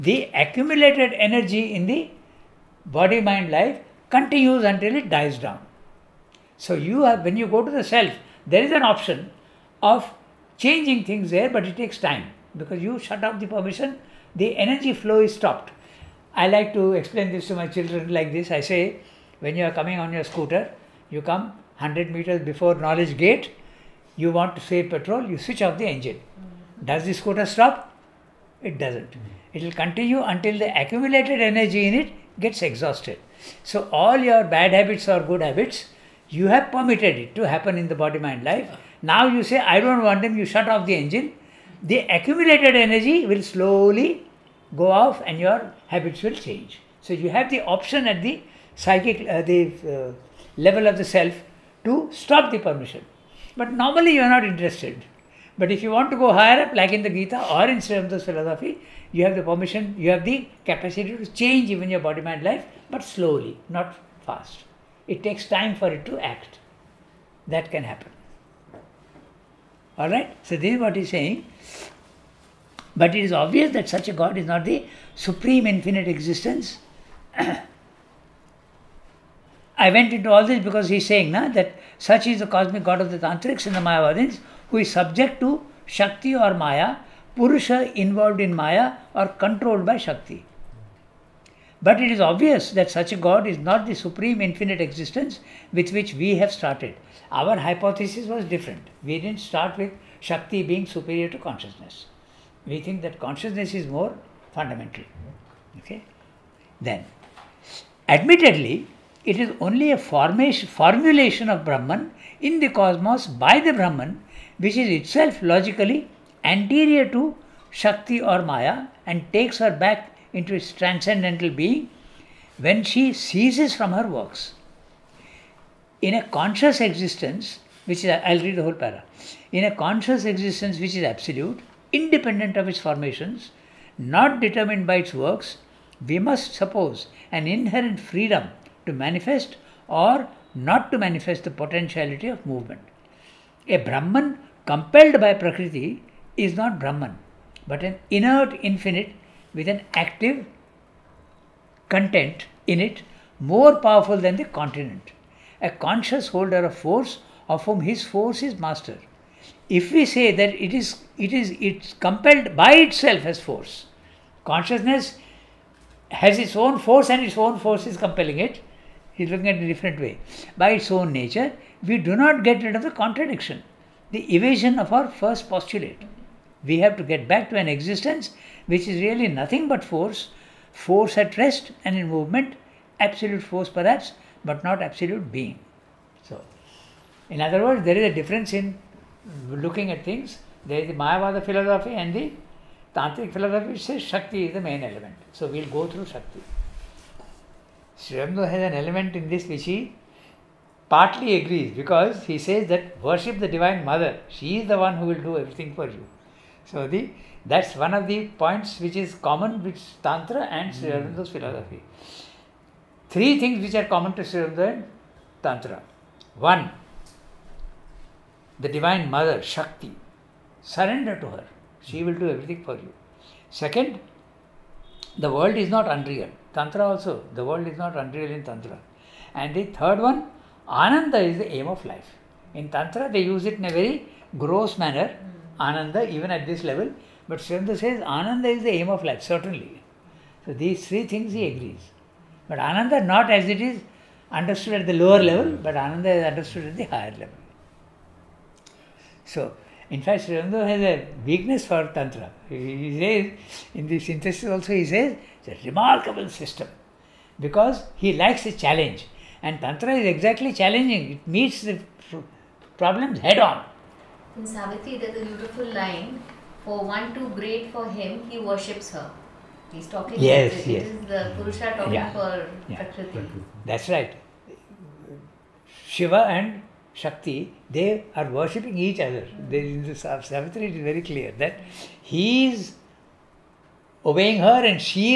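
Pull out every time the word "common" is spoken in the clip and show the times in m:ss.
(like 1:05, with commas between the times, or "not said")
3:29, 3:33.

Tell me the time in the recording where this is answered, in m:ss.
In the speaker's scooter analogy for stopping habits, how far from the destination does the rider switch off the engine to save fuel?
0:21.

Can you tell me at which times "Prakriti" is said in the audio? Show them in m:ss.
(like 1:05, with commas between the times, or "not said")
2:25, 4:32.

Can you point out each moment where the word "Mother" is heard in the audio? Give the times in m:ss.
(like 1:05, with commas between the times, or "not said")
3:23, 3:39.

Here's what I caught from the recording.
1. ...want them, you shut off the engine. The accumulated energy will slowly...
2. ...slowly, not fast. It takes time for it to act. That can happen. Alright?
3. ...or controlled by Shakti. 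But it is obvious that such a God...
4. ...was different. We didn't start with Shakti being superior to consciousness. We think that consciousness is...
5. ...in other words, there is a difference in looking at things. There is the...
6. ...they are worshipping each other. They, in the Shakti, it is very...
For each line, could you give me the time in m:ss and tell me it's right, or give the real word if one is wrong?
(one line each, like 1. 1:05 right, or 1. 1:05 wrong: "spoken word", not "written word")
1. 0:40 right
2. 1:03 right
3. 1:29 right
4. 1:38 right
5. 3:07 right
6. 4:37 wrong: "Savitri", not "Shakti".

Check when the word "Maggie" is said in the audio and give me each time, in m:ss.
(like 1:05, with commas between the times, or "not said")
not said.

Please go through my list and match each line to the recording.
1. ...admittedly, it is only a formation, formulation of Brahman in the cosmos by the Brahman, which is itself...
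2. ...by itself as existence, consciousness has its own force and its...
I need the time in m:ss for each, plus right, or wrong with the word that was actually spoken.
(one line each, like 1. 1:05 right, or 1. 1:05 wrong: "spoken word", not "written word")
1. 1:48 right
2. 2:42 wrong: "force", not "existence".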